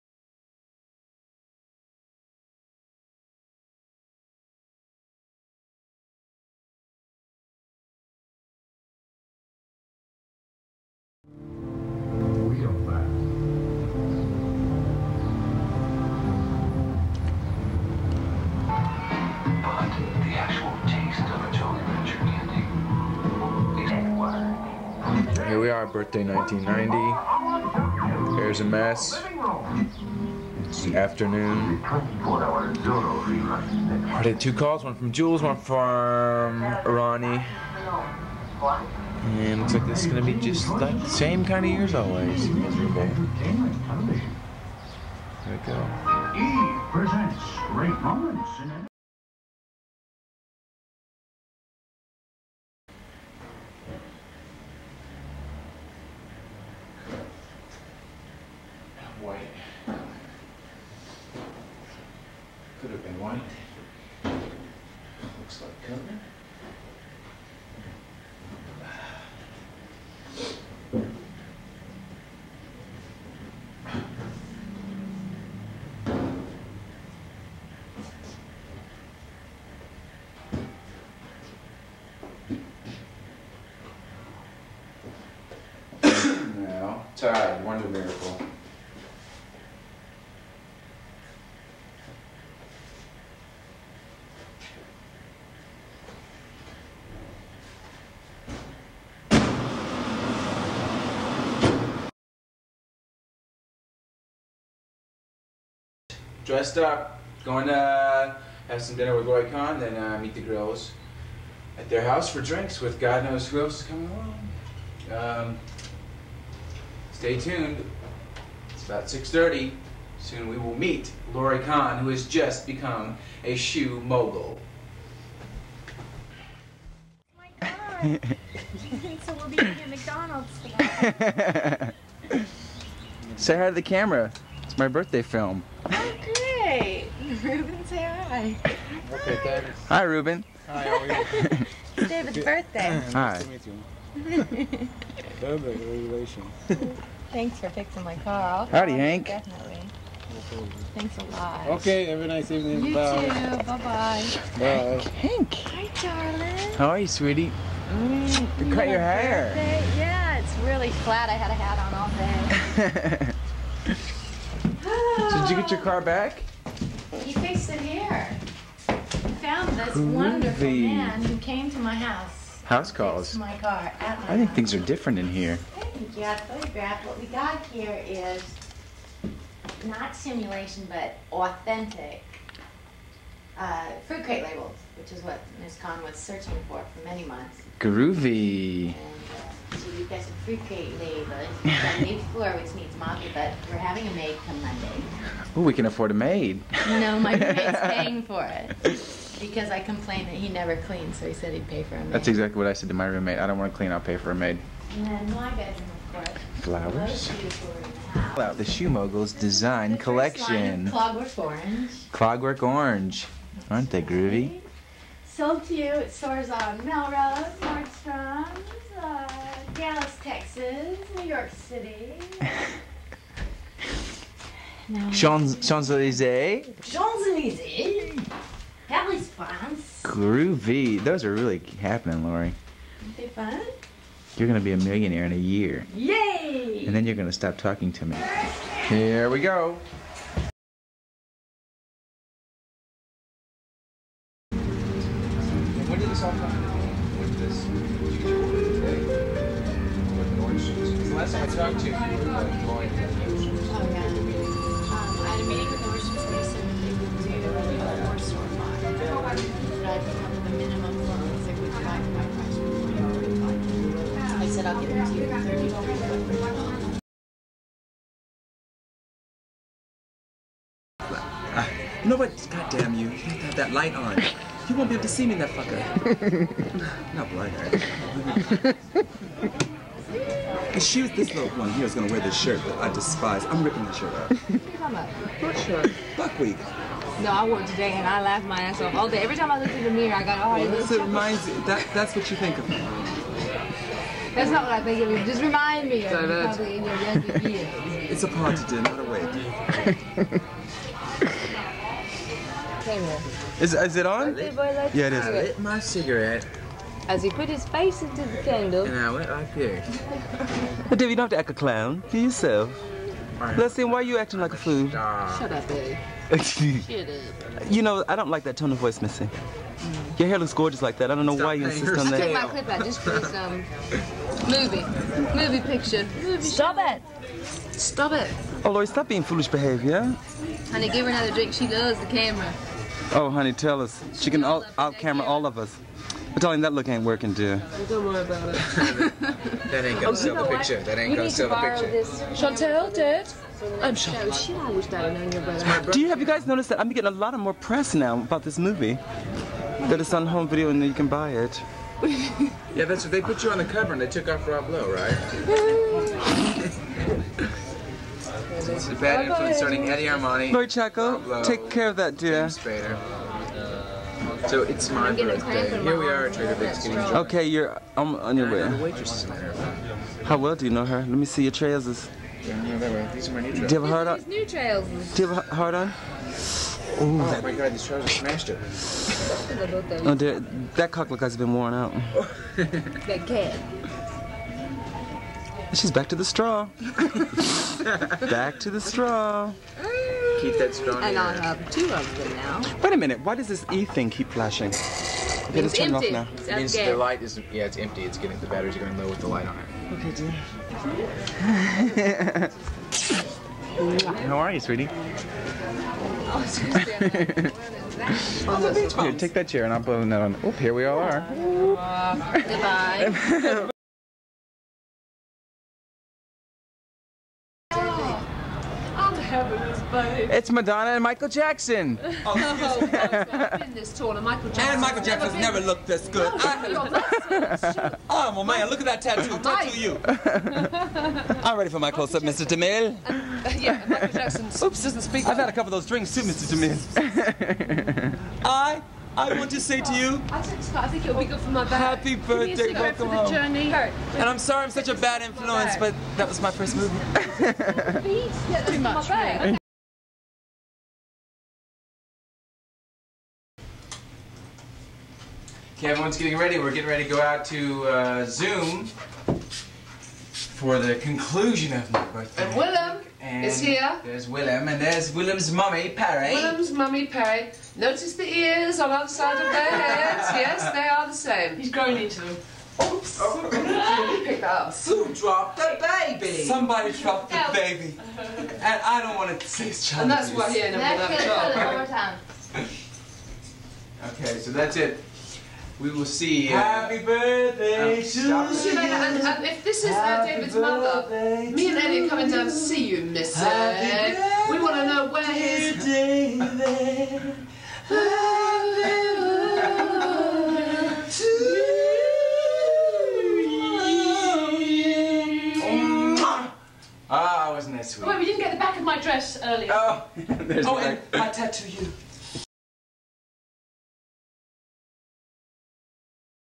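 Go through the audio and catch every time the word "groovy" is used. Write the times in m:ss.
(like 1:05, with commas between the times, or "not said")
2:49, 3:07, 3:34, 3:50.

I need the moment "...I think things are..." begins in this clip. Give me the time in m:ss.
2:54.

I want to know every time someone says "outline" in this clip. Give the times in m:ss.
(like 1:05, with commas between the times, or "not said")
not said.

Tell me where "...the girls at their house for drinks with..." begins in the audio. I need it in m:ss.
1:50.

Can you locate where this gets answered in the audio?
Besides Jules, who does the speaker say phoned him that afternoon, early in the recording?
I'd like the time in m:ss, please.
0:36.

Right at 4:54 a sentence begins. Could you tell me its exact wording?
That's not what I think of you.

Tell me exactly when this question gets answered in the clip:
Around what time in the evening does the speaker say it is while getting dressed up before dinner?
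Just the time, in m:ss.
1:59.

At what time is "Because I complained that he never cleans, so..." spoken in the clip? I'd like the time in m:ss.
3:19.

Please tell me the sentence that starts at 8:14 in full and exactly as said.
We want to know where he's.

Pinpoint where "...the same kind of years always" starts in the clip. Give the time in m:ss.
0:41.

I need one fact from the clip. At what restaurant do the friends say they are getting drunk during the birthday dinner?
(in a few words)
Trader Vic's.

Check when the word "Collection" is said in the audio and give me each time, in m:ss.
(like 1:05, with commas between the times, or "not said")
3:29.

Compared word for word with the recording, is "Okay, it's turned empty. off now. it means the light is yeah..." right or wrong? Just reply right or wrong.
right.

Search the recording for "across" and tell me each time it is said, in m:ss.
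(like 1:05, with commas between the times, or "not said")
not said.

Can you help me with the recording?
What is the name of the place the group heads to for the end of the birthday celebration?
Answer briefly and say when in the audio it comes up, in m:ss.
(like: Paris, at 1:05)
Zoom, at 7:38.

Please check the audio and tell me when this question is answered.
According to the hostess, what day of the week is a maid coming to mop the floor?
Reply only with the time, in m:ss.
3:14.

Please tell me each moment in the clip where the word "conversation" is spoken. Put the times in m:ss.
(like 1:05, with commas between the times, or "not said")
not said.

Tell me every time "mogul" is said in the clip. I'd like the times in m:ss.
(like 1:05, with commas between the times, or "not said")
2:04, 3:28.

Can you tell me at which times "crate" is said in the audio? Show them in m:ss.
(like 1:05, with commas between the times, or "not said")
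3:04.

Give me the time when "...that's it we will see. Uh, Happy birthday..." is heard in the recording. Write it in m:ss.
8:04.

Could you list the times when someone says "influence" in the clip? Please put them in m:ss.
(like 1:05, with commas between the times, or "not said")
5:59, 7:25.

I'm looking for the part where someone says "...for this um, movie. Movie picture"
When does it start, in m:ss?
5:22.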